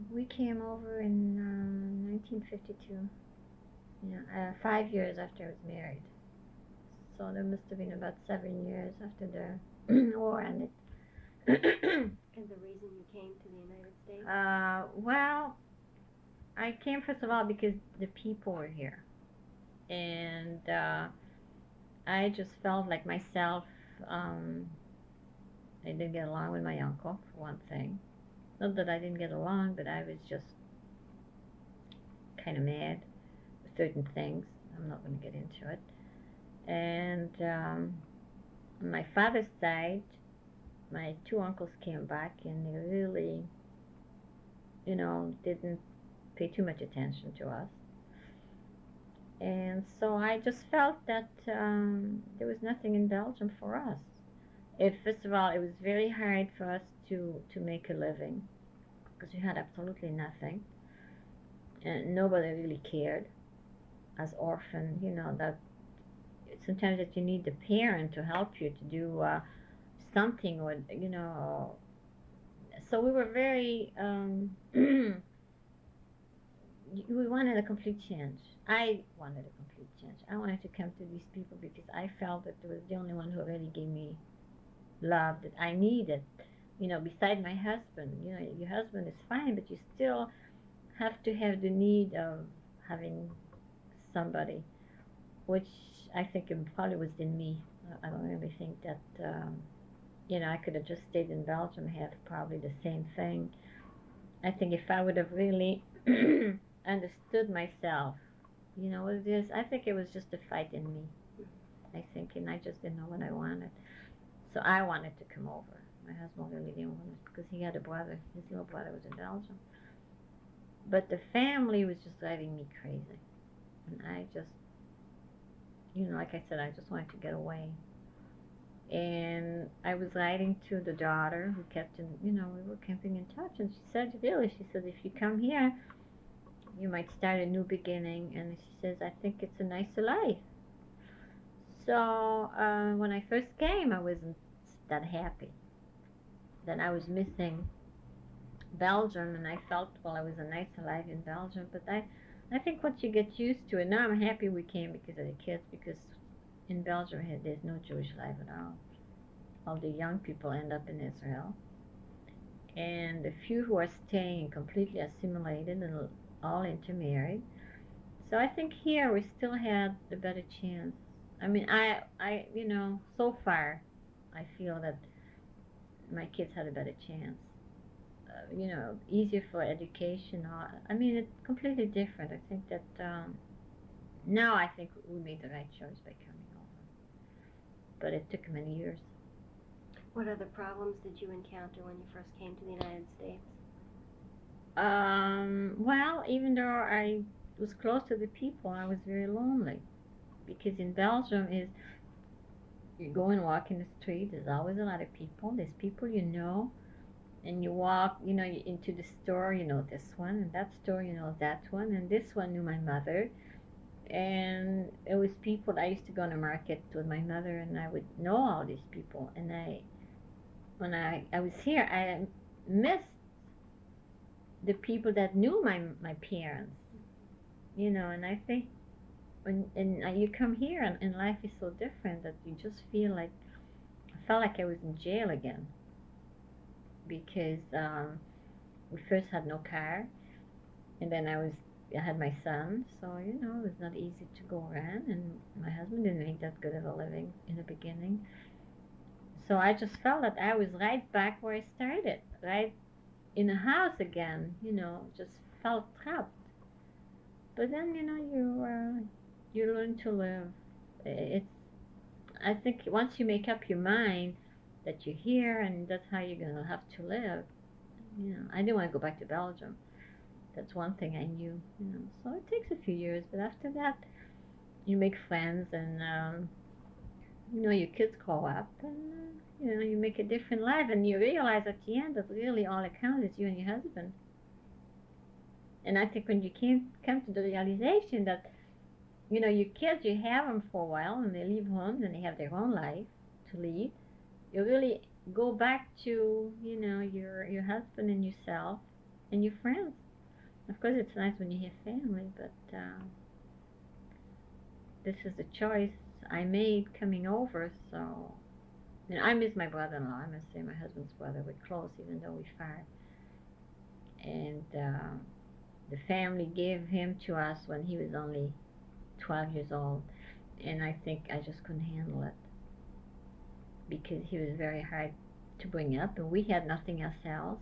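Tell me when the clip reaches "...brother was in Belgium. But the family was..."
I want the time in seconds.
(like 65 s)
118 s.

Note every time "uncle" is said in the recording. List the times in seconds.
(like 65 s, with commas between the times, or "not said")
26 s, 41 s.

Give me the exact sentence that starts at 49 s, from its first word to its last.
And so I just felt that um, there was nothing in Belgium for us.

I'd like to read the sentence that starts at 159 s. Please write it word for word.
All the young people end up in Israel.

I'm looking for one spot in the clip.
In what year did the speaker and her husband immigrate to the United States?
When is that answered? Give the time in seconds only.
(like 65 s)
2 s.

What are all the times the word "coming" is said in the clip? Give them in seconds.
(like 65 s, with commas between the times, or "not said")
186 s, 306 s.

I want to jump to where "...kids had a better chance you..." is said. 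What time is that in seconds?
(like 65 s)
176 s.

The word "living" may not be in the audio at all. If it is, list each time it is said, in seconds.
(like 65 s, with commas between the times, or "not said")
57 s, 246 s.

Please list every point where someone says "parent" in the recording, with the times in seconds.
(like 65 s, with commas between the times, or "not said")
67 s, 226 s.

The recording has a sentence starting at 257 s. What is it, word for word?
But then you know you uh, you learn to live.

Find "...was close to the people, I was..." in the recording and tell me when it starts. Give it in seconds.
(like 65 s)
197 s.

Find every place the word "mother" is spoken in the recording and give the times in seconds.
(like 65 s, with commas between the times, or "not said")
212 s, 217 s.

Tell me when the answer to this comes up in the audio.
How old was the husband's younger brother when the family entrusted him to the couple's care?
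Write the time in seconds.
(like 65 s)
319 s.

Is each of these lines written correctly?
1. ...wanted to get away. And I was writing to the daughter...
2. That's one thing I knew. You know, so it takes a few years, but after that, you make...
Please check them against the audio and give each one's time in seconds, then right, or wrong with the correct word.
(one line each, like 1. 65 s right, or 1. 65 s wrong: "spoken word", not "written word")
1. 126 s right
2. 270 s right.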